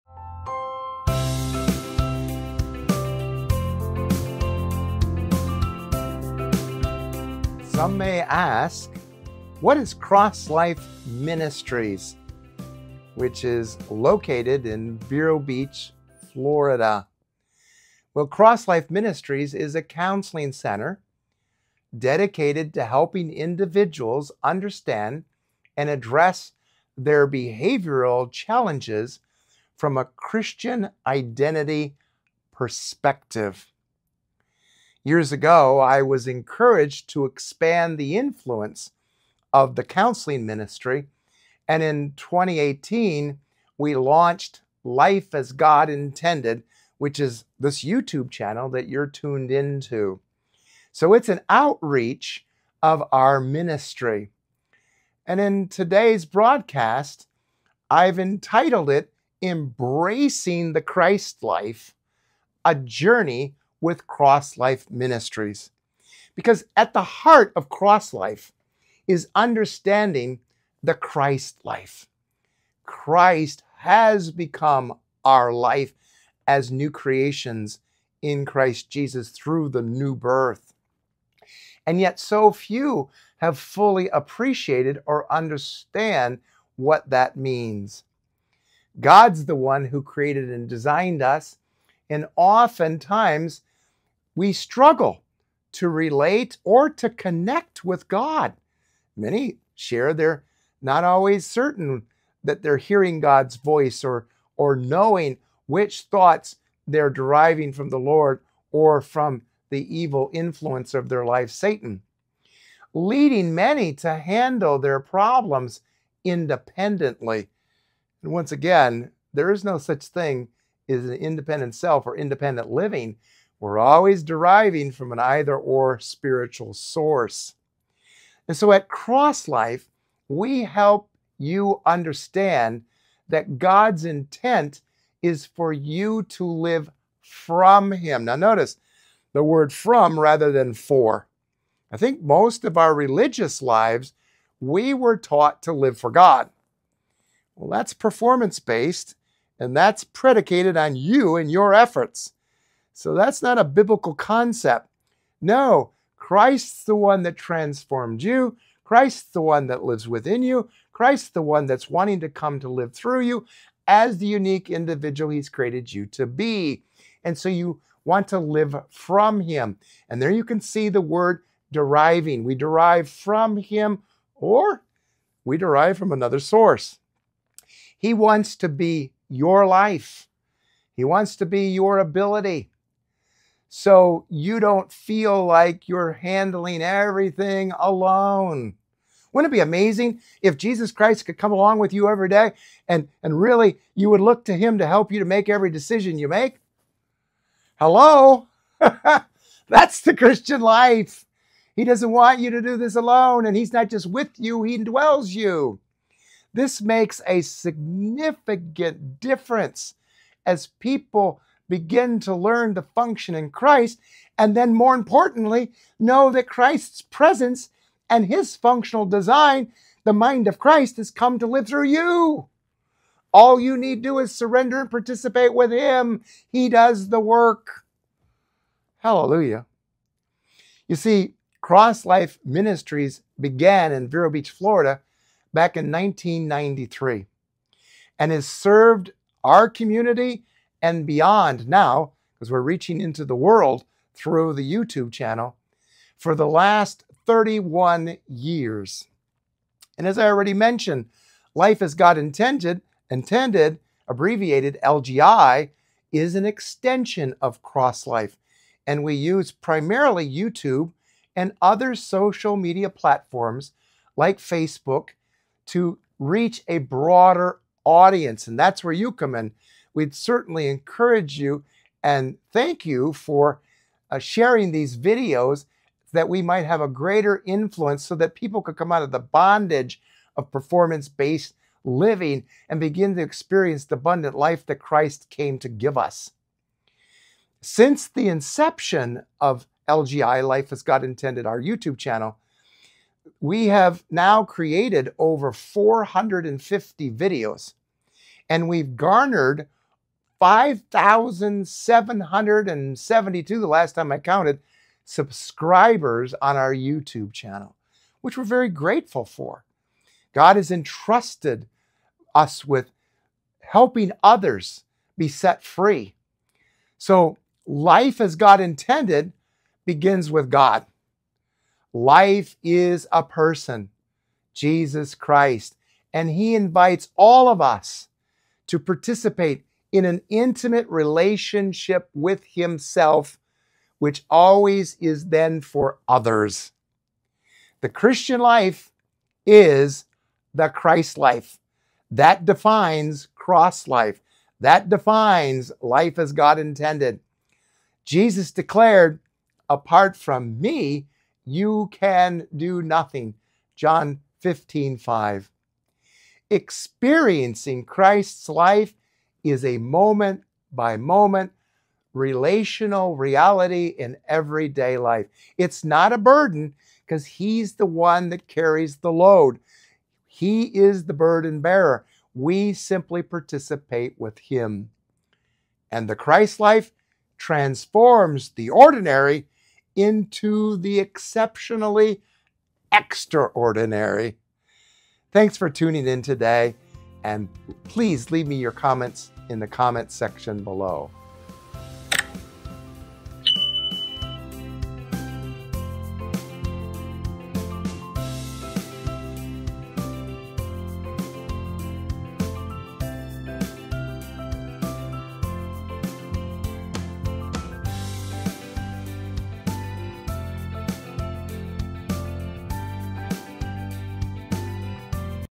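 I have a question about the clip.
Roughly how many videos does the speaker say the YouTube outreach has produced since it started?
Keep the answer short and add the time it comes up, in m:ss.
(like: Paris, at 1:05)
over 450, at 4:55.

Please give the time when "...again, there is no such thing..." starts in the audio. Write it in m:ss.
1:58.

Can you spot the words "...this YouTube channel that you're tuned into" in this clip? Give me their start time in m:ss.
0:47.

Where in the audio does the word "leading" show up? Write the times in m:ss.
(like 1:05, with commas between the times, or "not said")
1:52.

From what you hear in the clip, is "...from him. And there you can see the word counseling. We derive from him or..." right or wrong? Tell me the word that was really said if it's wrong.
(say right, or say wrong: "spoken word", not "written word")
wrong: "deriving", not "counseling".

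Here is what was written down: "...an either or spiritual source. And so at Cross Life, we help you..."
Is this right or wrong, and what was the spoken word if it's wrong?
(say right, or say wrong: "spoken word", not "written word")
right.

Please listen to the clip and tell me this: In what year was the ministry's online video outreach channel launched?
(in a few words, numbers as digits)
2018.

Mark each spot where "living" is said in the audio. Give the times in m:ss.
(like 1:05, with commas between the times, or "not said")
2:02, 4:41.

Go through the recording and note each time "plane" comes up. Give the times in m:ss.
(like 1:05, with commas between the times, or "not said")
not said.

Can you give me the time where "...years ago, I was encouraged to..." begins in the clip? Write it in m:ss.
0:35.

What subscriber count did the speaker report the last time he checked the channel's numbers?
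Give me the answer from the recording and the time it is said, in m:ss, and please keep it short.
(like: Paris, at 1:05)
5,772, at 5:00.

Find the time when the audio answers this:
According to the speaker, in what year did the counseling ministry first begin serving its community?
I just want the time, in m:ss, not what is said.
3:55.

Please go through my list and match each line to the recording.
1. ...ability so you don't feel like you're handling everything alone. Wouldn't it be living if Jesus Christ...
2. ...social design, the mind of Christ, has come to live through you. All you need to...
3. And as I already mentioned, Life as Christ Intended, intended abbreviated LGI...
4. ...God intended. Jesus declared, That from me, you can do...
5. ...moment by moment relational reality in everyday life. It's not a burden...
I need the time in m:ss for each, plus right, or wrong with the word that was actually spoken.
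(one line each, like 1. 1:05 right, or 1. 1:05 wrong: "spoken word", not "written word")
1. 3:01 wrong: "amazing", not "living"
2. 3:38 wrong: "functional", not "social"
3. 4:09 wrong: "God", not "Christ"
4. 5:46 wrong: "Apart", not "That"
5. 5:59 right.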